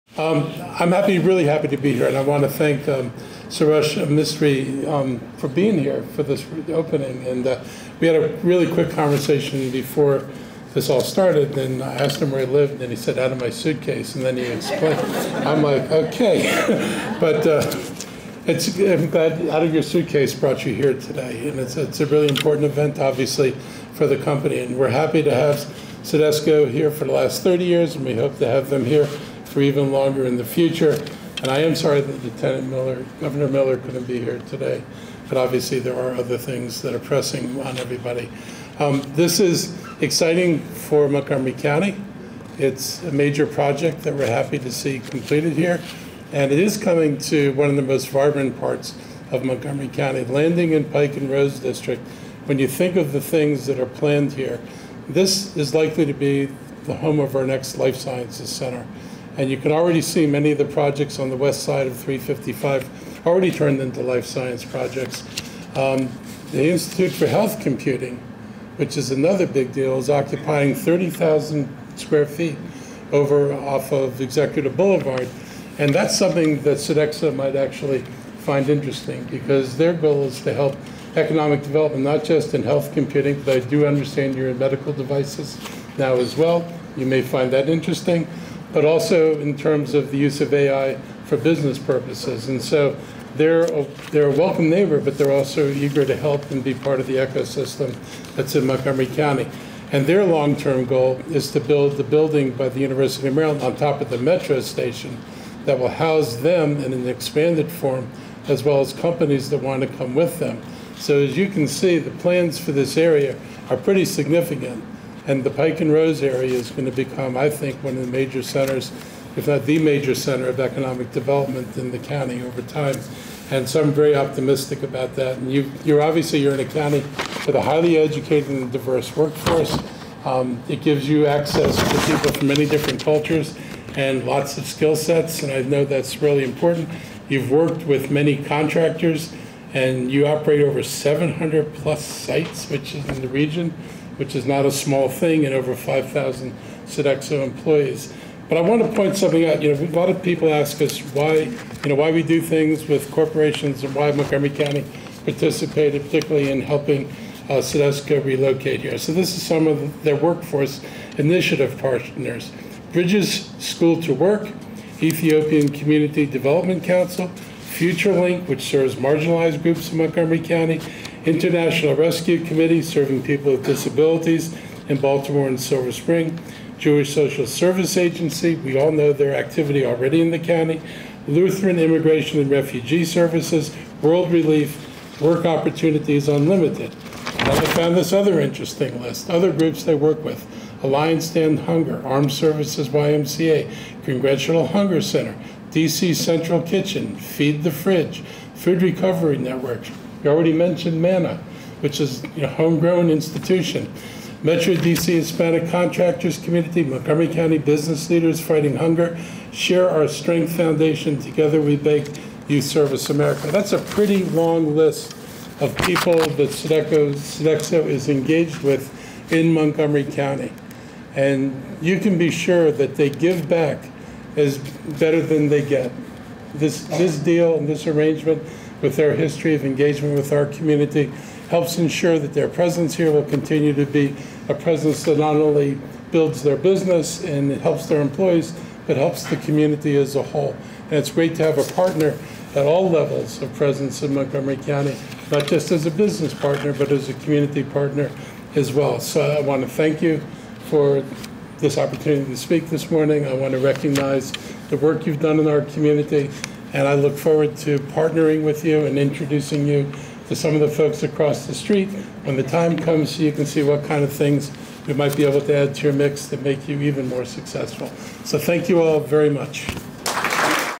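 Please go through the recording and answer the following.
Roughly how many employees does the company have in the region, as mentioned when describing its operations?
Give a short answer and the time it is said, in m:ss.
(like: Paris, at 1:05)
5,000, at 2:25.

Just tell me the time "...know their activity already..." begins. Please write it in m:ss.
2:58.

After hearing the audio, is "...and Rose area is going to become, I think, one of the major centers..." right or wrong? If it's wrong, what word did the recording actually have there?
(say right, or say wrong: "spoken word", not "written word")
right.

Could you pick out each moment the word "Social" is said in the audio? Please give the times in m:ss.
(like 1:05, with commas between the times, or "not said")
2:57.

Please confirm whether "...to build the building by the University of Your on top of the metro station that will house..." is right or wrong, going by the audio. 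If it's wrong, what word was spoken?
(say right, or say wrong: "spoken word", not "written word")
wrong: "Maryland", not "Your".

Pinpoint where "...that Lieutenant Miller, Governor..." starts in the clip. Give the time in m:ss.
0:32.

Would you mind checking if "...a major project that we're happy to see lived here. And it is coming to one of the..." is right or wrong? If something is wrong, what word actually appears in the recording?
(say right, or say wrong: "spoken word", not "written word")
wrong: "completed", not "lived".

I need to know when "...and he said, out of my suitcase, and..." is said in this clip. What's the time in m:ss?
0:12.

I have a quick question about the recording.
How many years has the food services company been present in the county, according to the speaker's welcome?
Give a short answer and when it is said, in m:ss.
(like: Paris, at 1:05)
30, at 0:27.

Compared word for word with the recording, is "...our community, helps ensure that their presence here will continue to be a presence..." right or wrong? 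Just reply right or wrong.
right.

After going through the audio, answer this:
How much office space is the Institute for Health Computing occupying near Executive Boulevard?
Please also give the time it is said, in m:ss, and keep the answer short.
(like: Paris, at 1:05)
30,000 square feet, at 1:10.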